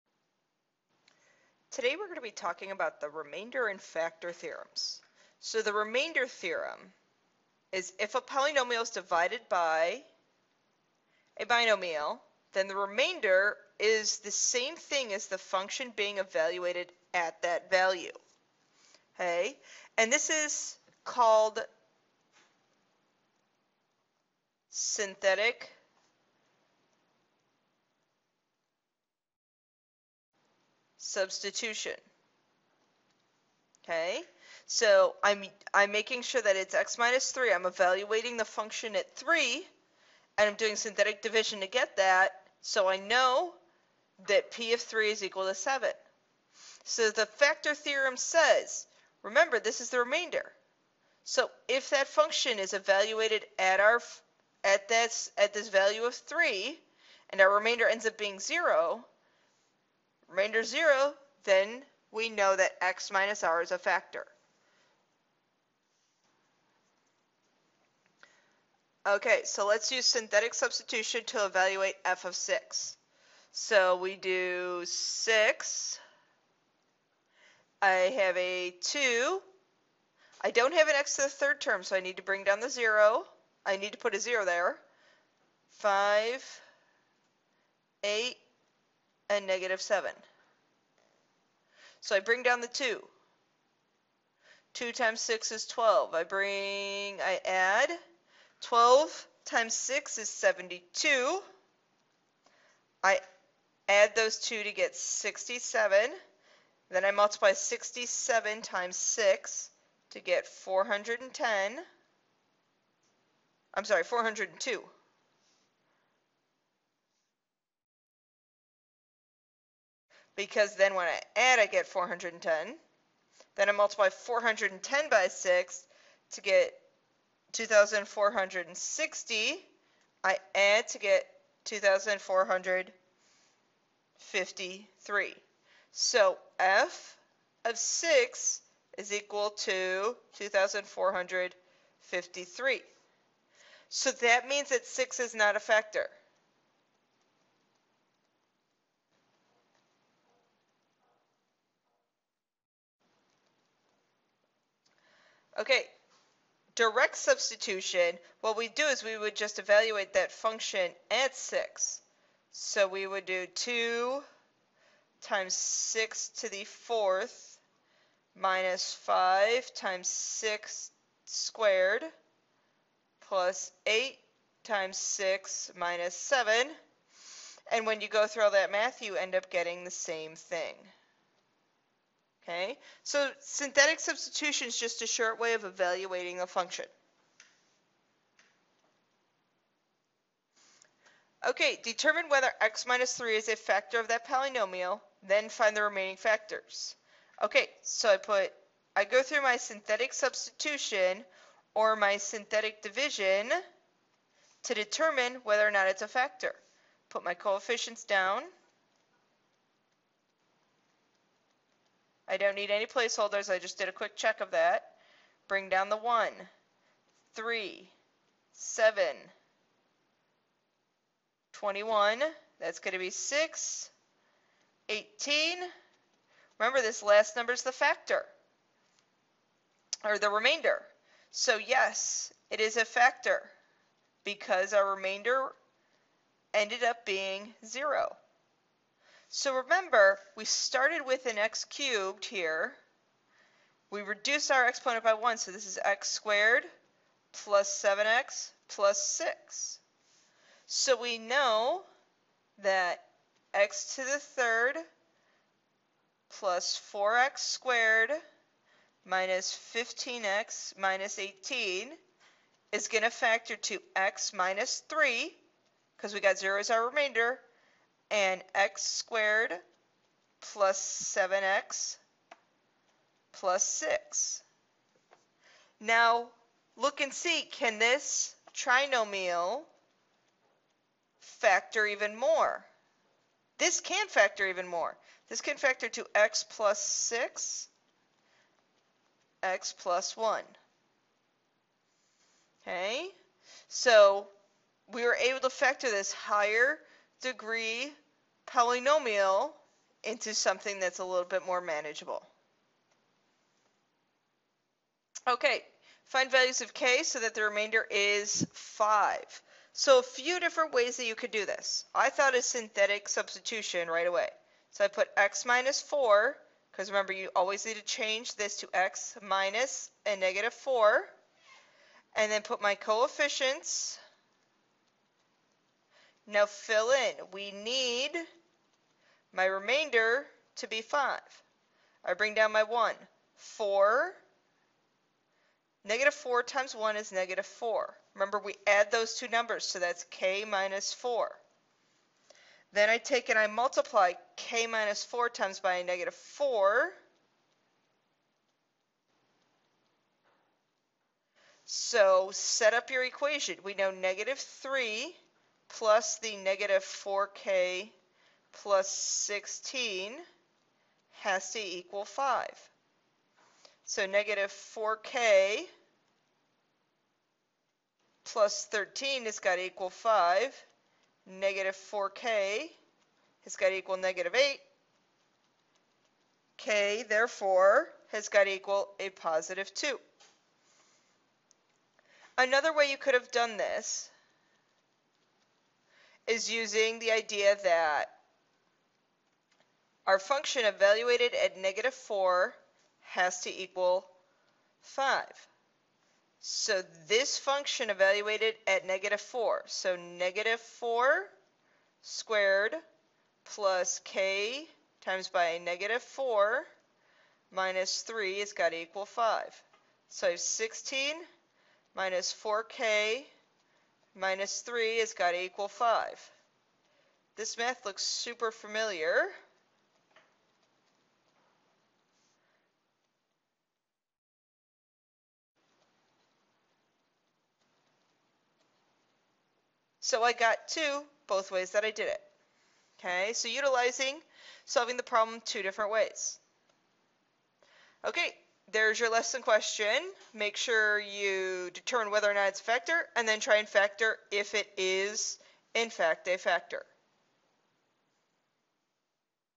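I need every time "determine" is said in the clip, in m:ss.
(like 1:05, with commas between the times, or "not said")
3:11, 3:24, 7:21.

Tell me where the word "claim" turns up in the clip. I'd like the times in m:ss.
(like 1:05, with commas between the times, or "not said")
not said.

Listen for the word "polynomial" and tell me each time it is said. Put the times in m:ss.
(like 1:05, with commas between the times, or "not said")
0:08, 3:14, 4:58.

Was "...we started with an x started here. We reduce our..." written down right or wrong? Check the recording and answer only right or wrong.
wrong.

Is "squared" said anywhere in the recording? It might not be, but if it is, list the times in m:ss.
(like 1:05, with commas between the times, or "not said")
2:51, 4:06, 4:17, 4:28, 6:42.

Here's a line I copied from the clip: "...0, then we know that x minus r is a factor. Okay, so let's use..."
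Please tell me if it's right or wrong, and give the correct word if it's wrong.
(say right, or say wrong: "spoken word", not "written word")
right.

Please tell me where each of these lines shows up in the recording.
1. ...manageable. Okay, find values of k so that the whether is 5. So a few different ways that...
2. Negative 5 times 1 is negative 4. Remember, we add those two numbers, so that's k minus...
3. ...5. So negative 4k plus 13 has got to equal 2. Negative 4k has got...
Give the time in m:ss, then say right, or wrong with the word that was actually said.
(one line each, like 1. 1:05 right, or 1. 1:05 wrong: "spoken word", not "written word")
1. 5:01 wrong: "remainder", not "whether"
2. 5:35 wrong: "4", not "5"
3. 6:02 wrong: "5", not "2".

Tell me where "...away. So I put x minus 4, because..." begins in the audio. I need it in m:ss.
5:14.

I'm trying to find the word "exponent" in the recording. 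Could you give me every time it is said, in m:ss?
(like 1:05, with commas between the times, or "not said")
4:04.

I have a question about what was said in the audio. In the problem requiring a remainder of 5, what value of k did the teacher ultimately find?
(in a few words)
2.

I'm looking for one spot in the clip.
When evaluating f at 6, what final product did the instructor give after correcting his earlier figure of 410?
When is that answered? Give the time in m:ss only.
1:54.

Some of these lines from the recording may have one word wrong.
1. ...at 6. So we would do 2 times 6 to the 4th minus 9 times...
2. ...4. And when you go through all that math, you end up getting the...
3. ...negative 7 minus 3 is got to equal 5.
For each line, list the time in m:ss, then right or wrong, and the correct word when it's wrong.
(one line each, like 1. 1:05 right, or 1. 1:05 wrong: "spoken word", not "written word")
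1. 2:41 wrong: "5", not "9"
2. 2:56 wrong: "7", not "4"
3. 6:45 wrong: "4", not "7".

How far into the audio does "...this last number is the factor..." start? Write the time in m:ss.
3:46.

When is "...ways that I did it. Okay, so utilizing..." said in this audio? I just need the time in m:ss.
7:11.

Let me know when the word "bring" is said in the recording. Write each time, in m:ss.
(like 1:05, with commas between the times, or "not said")
1:22, 1:32, 1:36, 3:35, 5:32.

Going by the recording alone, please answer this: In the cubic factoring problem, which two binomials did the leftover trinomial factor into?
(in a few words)
x + 6 and x + 1.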